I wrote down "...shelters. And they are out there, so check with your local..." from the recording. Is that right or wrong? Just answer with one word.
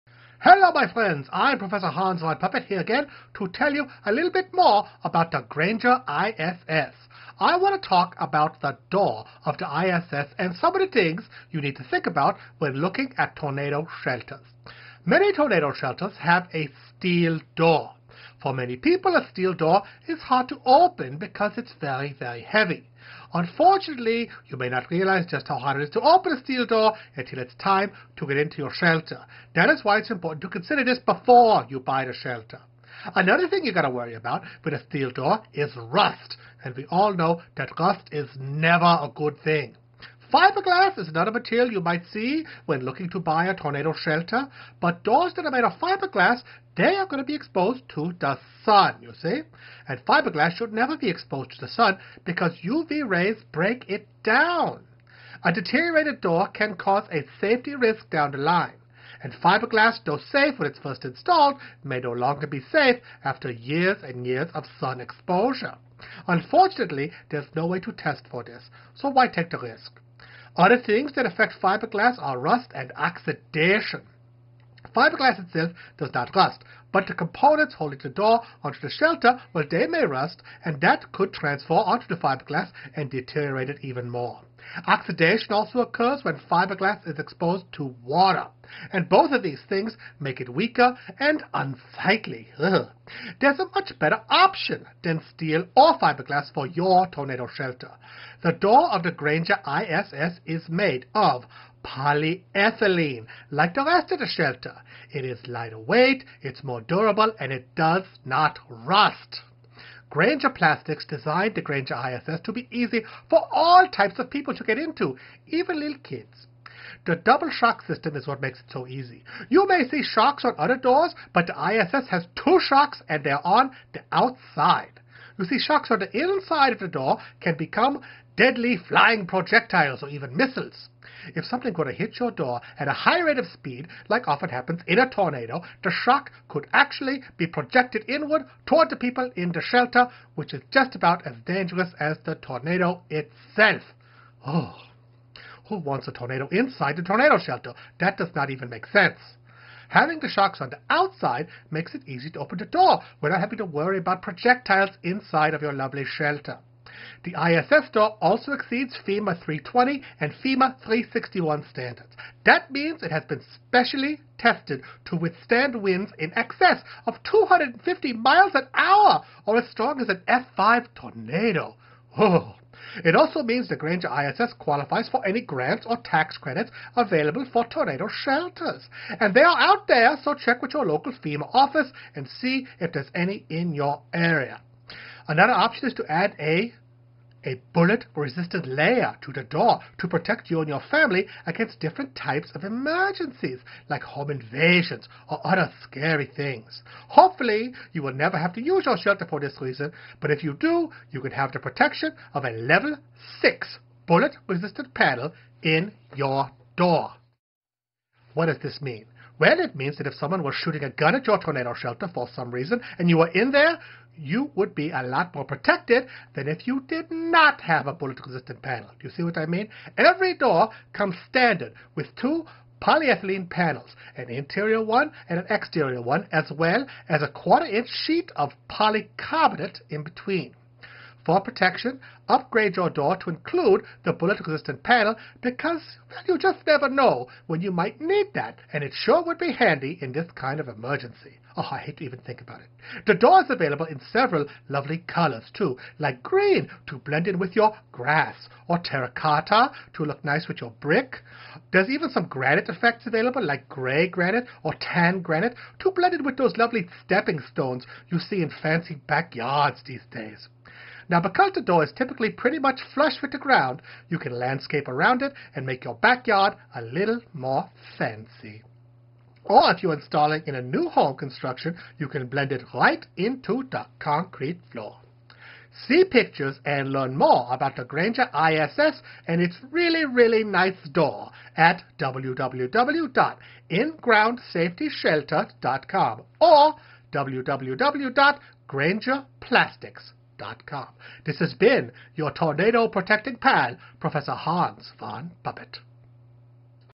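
right.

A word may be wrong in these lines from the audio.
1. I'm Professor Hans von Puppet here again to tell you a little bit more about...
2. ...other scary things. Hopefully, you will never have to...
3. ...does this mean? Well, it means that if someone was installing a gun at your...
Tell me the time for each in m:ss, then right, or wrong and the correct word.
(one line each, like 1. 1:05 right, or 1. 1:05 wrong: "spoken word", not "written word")
1. 0:01 right
2. 3:15 right
3. 3:28 wrong: "shooting", not "installing".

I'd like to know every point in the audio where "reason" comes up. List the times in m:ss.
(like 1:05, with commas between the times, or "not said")
3:19, 3:32.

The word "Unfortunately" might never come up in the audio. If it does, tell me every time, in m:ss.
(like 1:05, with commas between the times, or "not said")
0:23, 1:06.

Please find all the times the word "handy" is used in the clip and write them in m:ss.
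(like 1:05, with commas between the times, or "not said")
3:59.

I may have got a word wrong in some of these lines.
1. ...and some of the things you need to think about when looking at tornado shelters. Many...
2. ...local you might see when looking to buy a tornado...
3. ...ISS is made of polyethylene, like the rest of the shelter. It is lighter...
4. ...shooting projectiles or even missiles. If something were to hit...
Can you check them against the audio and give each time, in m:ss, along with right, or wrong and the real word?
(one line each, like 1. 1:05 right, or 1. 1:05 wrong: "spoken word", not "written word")
1. 0:10 right
2. 0:41 wrong: "material", not "local"
3. 1:39 right
4. 2:08 wrong: "flying", not "shooting".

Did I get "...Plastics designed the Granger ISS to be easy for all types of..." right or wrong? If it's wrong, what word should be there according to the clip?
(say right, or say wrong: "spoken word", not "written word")
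right.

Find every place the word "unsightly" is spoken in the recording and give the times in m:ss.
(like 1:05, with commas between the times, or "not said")
1:31.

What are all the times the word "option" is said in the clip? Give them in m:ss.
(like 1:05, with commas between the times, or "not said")
1:34, 3:05.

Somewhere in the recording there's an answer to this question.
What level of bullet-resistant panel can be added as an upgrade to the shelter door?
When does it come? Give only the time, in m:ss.
3:22.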